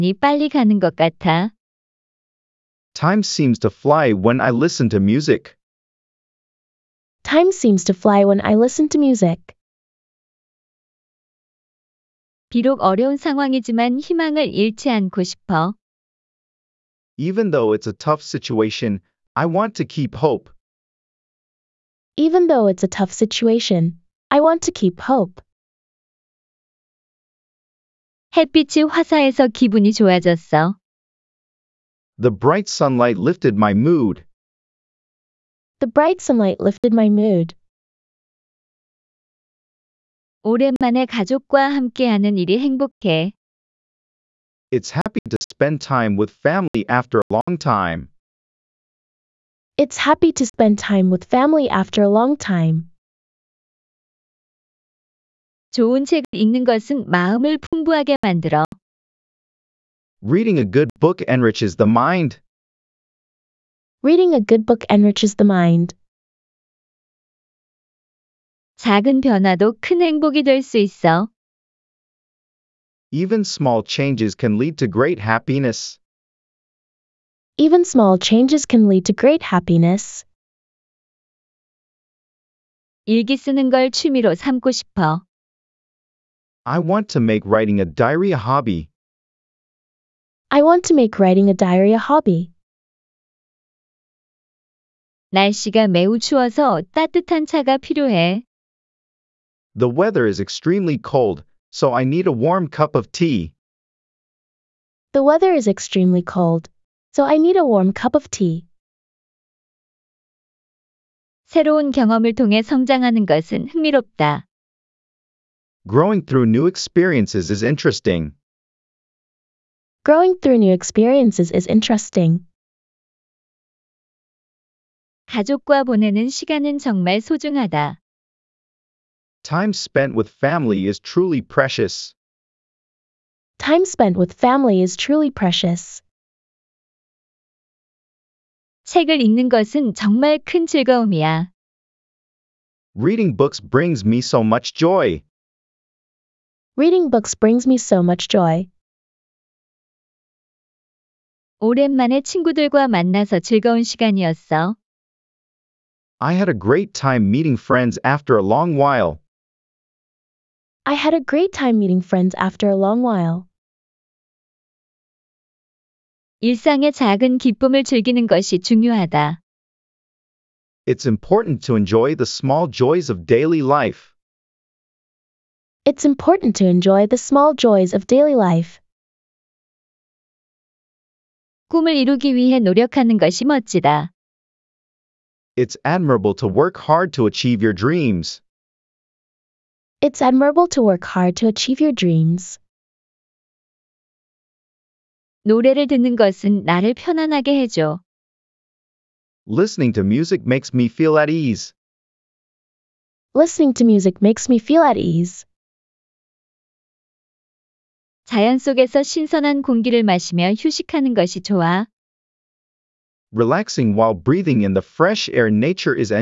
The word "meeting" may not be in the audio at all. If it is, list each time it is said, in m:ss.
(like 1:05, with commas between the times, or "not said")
2:37, 2:41.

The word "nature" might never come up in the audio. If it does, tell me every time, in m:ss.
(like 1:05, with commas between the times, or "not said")
3:35.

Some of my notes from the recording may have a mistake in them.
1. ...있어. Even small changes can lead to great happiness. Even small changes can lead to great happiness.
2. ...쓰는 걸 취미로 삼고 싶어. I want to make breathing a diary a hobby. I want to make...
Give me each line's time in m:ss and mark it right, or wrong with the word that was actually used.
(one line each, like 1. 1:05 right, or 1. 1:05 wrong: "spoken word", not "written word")
1. 1:10 right
2. 1:23 wrong: "writing", not "breathing".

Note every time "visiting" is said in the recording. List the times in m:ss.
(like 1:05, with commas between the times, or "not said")
not said.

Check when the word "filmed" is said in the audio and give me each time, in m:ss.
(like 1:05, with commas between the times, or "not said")
not said.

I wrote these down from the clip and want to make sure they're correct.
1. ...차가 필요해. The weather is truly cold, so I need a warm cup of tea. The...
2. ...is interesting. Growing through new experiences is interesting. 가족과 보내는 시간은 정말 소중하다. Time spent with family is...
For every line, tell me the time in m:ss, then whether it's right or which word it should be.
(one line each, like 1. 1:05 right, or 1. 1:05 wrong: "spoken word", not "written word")
1. 1:37 wrong: "extremely", not "truly"
2. 1:57 right.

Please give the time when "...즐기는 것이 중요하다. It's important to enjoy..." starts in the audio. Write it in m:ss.
2:47.